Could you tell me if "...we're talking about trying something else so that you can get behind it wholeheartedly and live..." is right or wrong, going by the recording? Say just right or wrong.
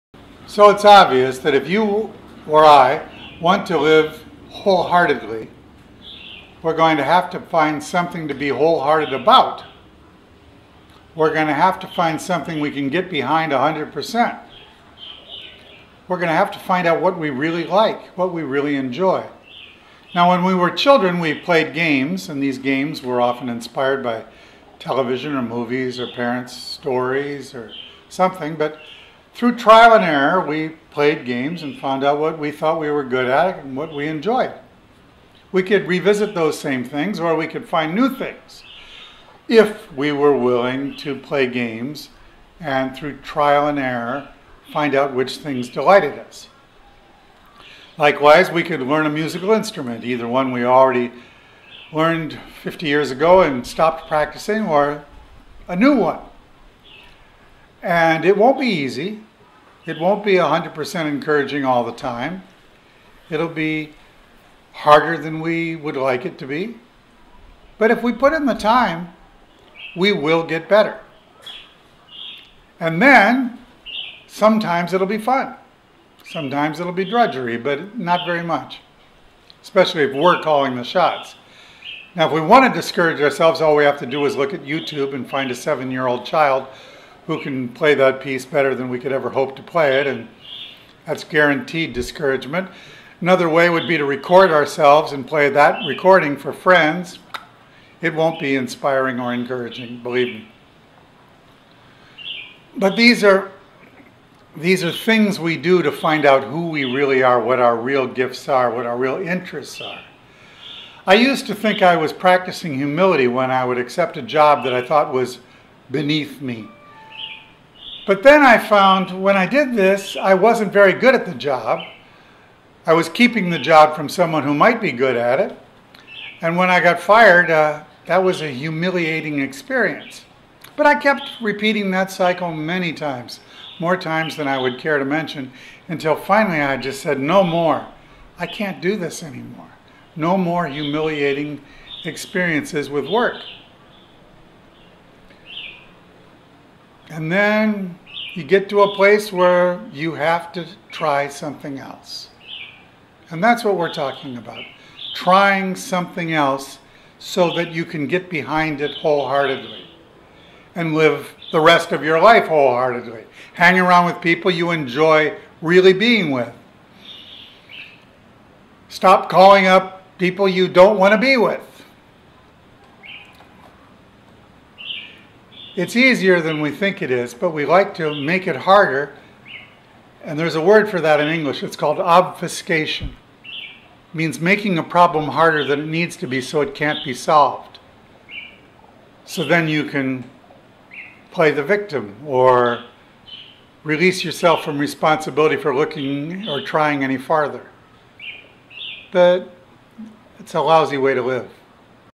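right.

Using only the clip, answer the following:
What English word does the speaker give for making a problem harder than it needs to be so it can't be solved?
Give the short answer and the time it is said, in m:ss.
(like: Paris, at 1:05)
obfuscation, at 3:01.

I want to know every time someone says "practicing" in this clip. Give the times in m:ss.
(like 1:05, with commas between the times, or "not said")
0:54, 1:52.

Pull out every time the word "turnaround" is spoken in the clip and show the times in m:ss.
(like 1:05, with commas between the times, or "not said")
not said.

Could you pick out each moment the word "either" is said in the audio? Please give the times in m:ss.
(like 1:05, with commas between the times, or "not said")
0:50.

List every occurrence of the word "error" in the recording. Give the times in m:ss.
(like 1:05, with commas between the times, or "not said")
0:30, 0:43.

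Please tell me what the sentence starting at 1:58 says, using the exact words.
But then I found when I did this, I wasn't very good at the job.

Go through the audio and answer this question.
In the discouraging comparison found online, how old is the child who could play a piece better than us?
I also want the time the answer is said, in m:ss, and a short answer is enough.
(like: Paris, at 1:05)
7, at 1:25.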